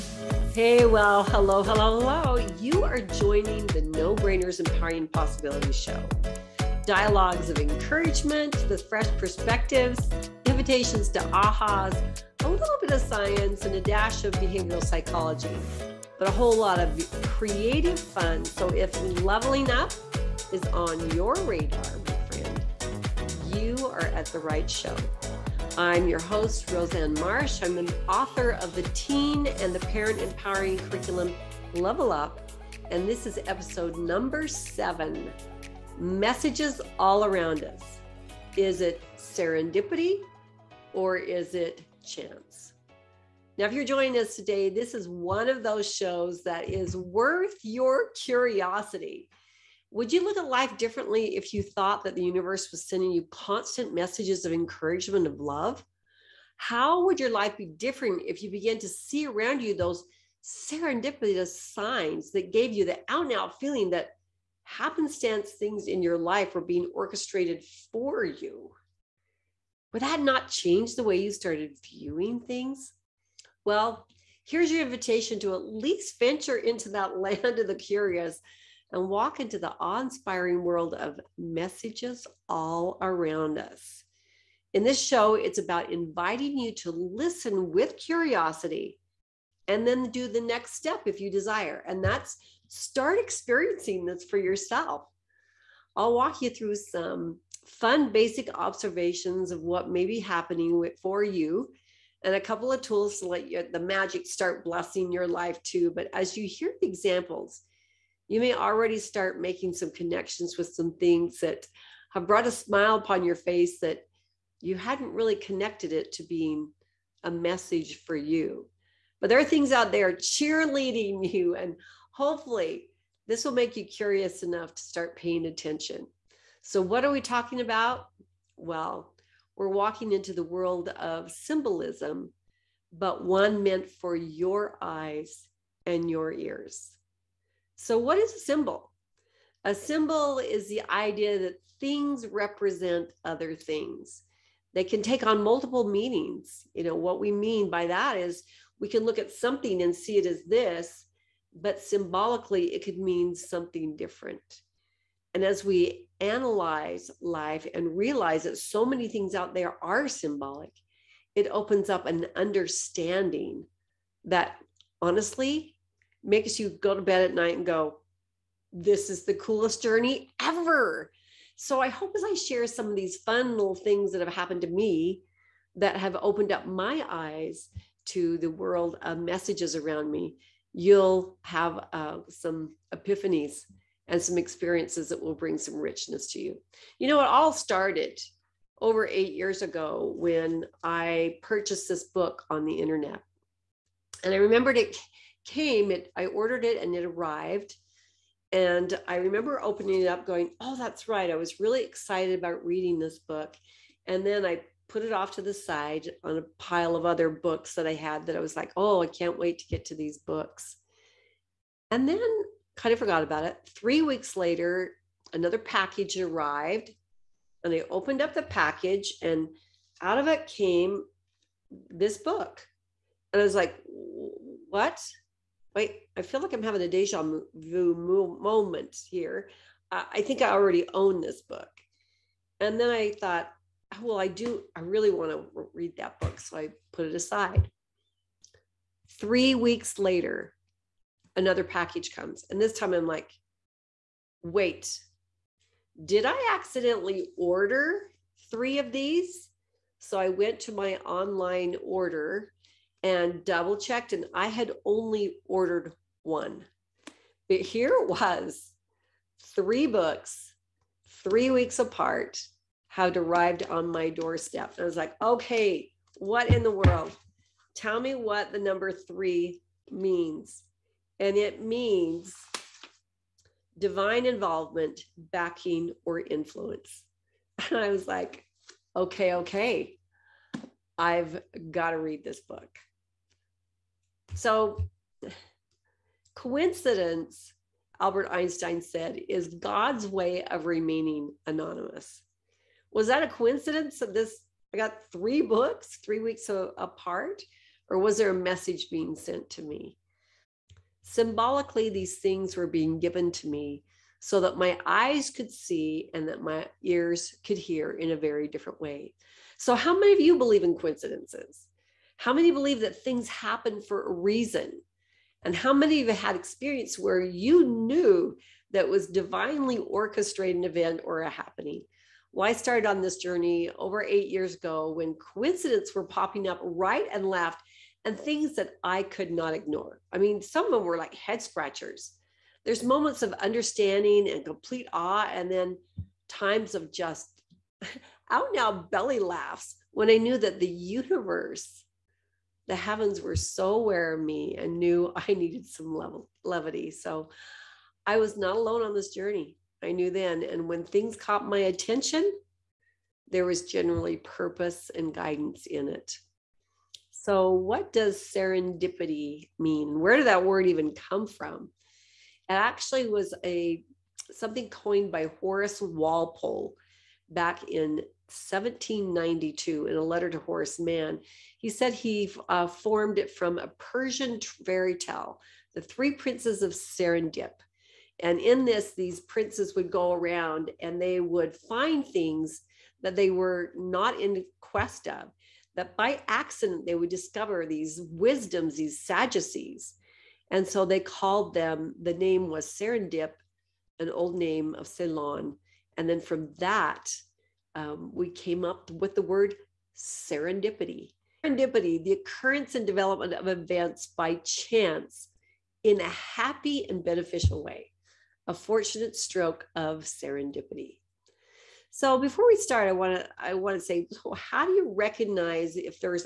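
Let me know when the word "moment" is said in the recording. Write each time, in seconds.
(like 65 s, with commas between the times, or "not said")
228 s, 332 s.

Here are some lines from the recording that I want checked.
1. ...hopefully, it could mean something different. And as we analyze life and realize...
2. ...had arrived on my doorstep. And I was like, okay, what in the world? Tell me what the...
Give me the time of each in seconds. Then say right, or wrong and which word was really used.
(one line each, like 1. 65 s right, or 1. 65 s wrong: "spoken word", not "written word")
1. 151 s wrong: "symbolically", not "hopefully"
2. 262 s right.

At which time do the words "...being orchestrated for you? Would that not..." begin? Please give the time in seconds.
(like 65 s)
66 s.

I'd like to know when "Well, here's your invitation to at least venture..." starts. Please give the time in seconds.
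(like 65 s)
73 s.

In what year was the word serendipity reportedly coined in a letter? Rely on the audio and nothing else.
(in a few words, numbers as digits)
1792.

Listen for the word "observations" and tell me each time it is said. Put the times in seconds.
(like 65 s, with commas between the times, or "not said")
98 s.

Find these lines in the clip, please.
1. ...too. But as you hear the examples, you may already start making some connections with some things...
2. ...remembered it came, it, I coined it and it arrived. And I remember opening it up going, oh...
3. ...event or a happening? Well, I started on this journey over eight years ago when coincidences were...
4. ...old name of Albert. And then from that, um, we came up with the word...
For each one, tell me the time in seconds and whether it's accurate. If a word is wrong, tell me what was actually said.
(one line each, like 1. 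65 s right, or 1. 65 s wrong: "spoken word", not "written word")
1. 105 s right
2. 194 s wrong: "ordered", not "coined"
3. 320 s right
4. 394 s wrong: "Ceylon", not "Albert".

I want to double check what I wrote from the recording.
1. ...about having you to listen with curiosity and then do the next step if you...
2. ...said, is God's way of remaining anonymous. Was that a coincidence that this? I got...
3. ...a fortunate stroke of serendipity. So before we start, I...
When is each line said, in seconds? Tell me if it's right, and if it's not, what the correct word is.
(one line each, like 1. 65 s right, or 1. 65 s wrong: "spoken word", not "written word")
1. 85 s wrong: "inviting", not "having"
2. 288 s right
3. 408 s right.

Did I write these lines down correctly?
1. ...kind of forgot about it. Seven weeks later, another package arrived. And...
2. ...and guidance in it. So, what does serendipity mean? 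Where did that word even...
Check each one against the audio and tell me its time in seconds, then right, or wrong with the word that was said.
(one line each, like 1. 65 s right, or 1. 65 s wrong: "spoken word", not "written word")
1. 212 s wrong: "Three", not "Seven"
2. 354 s right.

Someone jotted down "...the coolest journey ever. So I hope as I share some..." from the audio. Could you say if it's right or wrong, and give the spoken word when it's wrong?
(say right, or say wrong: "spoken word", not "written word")
right.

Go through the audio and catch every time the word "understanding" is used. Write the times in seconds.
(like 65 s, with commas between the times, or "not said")
162 s, 333 s.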